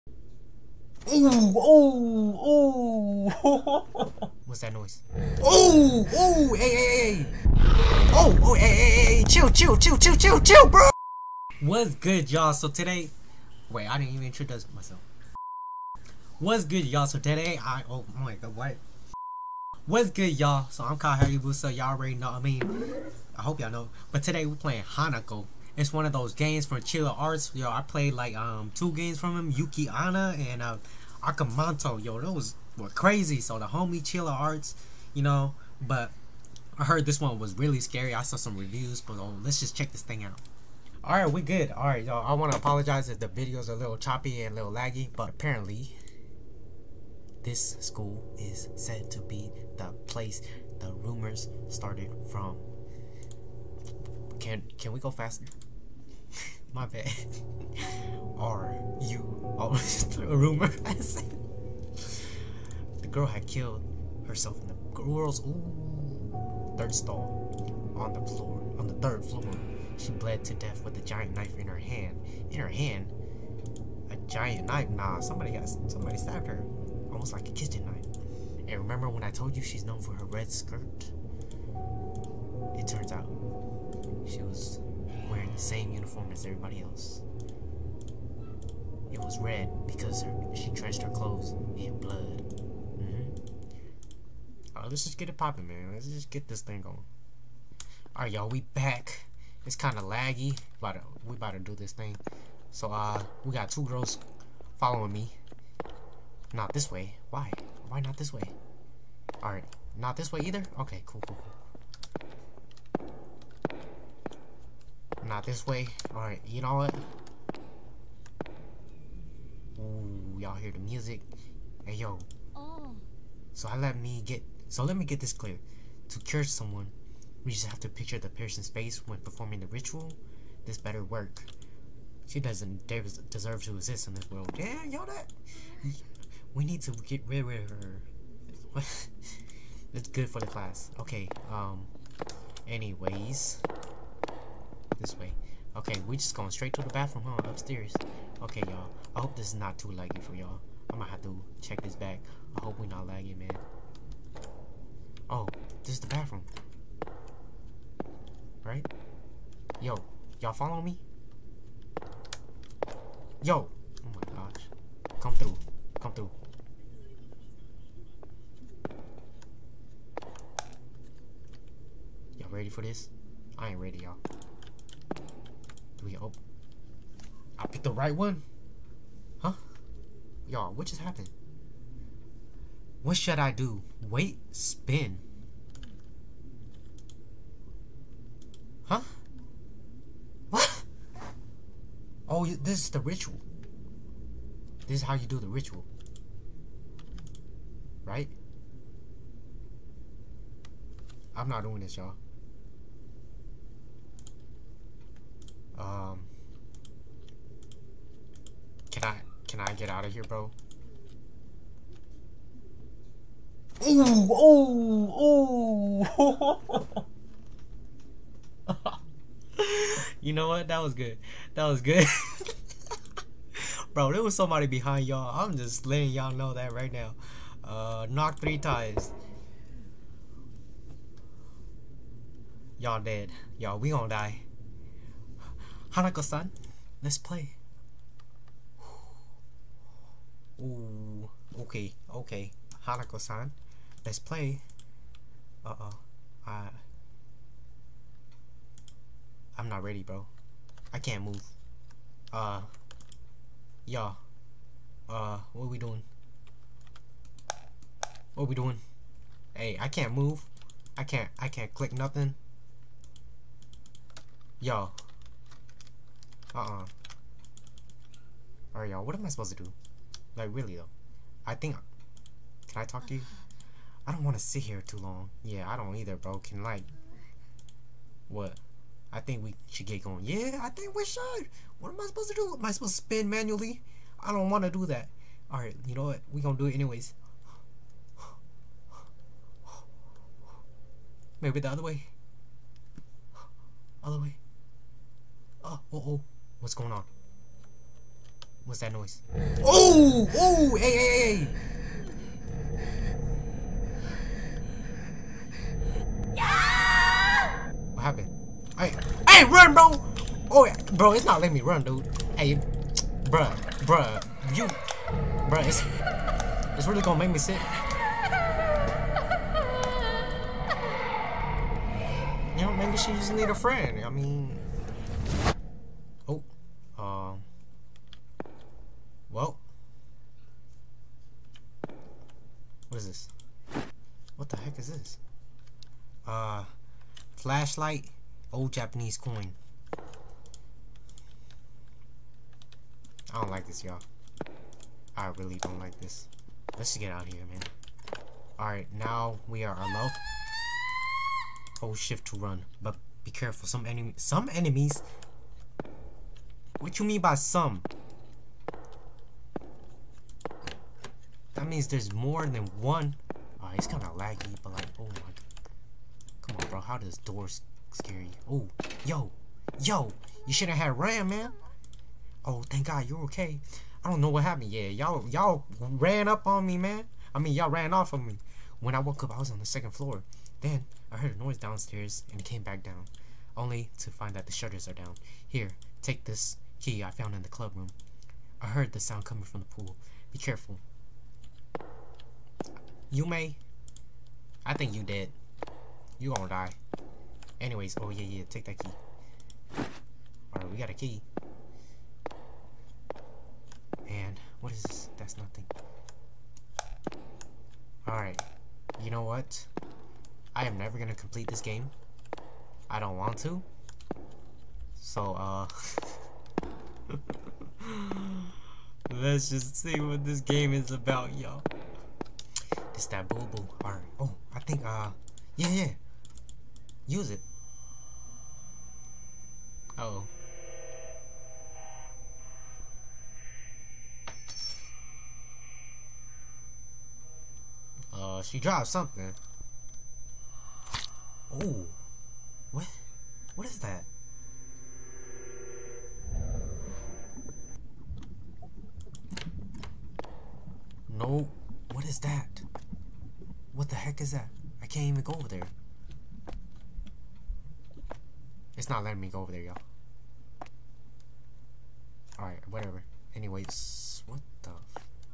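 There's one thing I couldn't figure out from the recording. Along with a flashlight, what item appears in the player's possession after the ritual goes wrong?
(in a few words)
old Japanese coin.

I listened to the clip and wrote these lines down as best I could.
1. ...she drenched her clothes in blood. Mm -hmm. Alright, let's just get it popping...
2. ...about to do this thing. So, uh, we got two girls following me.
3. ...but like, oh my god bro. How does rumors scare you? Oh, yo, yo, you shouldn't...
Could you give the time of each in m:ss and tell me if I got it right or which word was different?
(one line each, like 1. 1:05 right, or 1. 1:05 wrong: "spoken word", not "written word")
1. 1:30 right
2. 1:41 right
3. 6:04 wrong: "doors", not "rumors".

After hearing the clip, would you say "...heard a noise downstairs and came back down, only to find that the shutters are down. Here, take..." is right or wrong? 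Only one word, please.
right.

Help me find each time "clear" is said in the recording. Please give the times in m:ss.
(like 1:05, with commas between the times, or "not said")
2:05.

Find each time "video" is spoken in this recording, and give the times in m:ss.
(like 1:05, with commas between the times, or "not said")
0:43.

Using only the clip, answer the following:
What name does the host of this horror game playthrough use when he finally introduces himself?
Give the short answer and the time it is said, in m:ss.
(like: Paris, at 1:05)
Kai Hayabusa, at 0:20.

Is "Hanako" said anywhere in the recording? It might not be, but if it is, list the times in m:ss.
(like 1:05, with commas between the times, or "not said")
0:24, 3:55, 4:02.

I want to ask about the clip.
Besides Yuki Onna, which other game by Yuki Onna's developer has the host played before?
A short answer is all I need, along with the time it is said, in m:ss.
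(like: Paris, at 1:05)
Aka Manto, at 0:31.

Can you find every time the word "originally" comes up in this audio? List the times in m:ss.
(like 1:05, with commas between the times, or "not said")
not said.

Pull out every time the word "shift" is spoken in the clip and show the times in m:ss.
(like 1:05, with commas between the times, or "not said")
5:51.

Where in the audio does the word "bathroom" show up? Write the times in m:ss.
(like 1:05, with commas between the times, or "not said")
2:26, 2:36.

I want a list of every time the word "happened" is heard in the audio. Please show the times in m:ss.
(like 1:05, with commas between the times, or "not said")
3:01, 5:08, 6:14.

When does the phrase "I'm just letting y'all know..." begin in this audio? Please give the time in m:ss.
3:45.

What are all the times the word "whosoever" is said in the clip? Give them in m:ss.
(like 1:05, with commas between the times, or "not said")
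not said.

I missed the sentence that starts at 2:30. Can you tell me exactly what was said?
I'm gonna have to check this back.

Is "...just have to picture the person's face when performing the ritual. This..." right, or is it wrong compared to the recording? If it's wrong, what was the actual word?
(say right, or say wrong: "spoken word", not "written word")
right.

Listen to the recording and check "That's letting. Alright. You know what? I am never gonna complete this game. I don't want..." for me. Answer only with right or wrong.
wrong.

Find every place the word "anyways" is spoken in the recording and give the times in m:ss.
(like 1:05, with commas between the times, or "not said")
2:22, 4:46, 6:37, 7:43.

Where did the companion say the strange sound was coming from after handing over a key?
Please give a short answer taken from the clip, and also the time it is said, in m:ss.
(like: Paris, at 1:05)
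the pool, at 6:29.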